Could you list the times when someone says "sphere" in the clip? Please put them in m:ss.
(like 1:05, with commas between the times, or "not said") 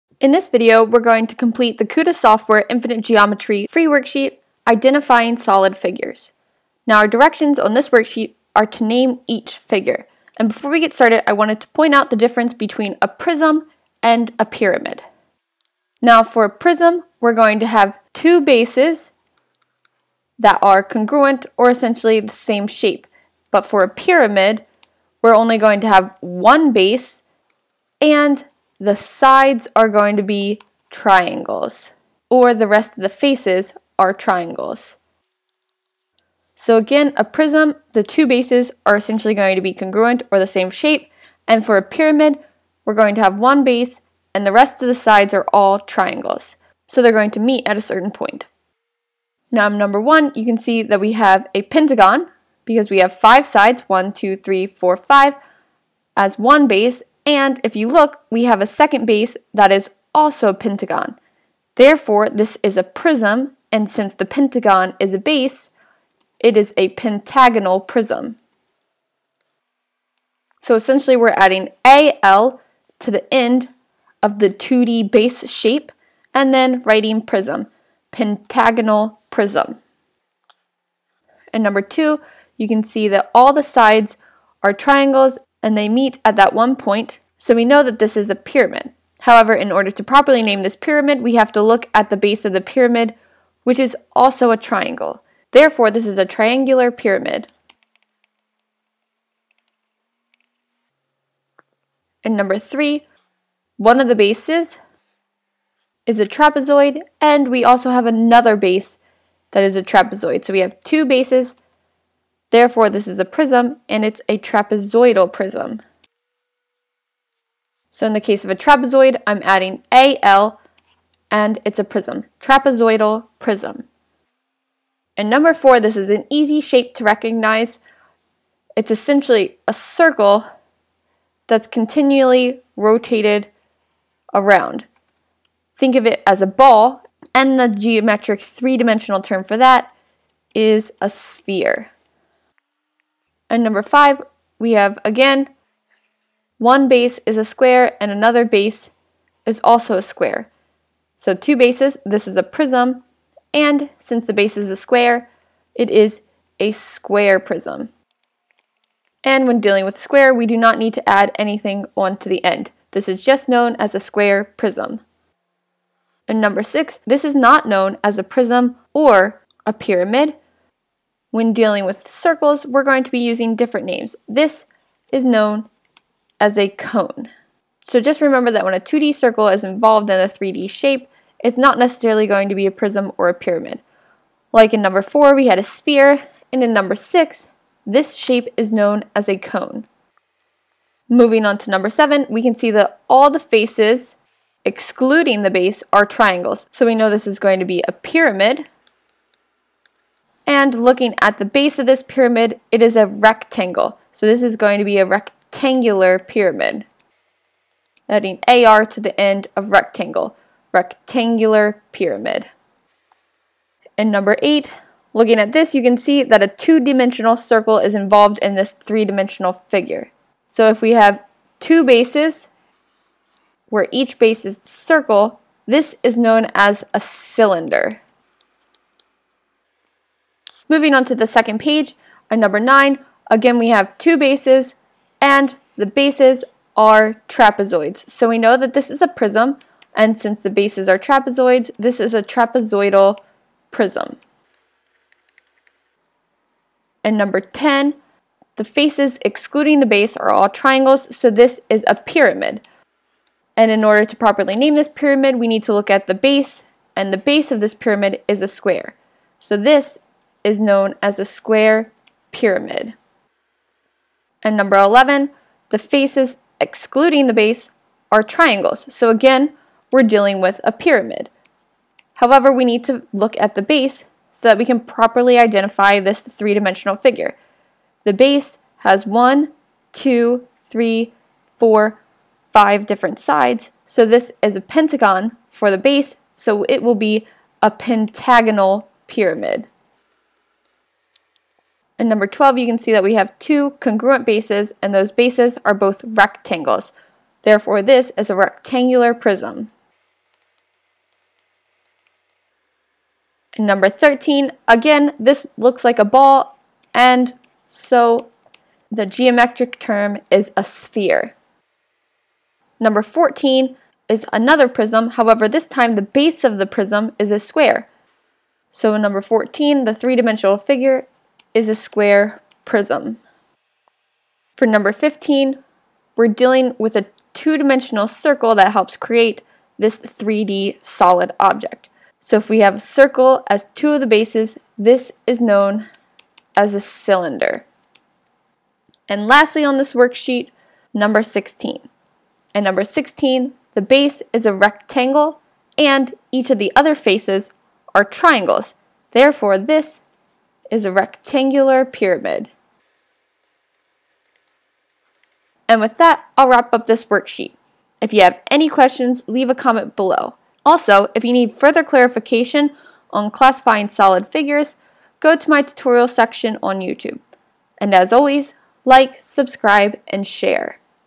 2:21, 3:05, 5:10.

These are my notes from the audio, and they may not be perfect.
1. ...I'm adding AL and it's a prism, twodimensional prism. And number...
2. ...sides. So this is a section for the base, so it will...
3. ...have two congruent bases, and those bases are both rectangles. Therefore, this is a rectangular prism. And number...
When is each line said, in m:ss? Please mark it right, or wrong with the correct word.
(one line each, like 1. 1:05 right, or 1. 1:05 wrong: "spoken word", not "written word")
1. 1:59 wrong: "trapezoidal", not "twodimensional"
2. 4:43 wrong: "pentagon", not "section"
3. 4:53 right.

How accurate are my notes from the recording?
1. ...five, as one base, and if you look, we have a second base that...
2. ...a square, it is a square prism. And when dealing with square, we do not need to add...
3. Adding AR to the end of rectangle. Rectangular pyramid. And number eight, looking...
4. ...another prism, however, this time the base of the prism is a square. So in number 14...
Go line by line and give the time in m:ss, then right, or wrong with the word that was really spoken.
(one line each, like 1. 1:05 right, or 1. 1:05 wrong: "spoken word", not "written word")
1. 0:54 right
2. 2:34 right
3. 3:28 right
4. 5:14 right.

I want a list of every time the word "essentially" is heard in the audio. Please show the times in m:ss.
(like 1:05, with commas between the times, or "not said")
0:21, 0:38, 1:10, 2:08.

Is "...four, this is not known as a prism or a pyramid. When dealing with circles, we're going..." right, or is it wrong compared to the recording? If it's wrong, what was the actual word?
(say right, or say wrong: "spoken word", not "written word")
wrong: "six", not "four".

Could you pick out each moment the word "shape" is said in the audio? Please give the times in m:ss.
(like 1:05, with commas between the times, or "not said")
0:22, 0:40, 1:15, 2:06, 3:00, 3:08.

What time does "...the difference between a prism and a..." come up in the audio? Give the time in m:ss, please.
0:12.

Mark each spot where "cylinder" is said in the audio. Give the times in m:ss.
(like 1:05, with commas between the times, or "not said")
3:46, 5:36.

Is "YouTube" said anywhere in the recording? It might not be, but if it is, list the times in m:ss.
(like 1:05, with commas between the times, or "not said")
6:06.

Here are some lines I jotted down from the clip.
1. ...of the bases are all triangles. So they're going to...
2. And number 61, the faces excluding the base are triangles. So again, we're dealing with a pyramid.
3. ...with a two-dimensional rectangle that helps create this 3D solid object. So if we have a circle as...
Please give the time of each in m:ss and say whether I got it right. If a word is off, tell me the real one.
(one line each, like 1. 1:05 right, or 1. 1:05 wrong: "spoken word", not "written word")
1. 0:44 wrong: "sides", not "bases"
2. 4:24 wrong: "11", not "61"
3. 5:26 wrong: "circle", not "rectangle".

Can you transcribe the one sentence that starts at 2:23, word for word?
And number five, we have again, one base is a square and another base is also a square.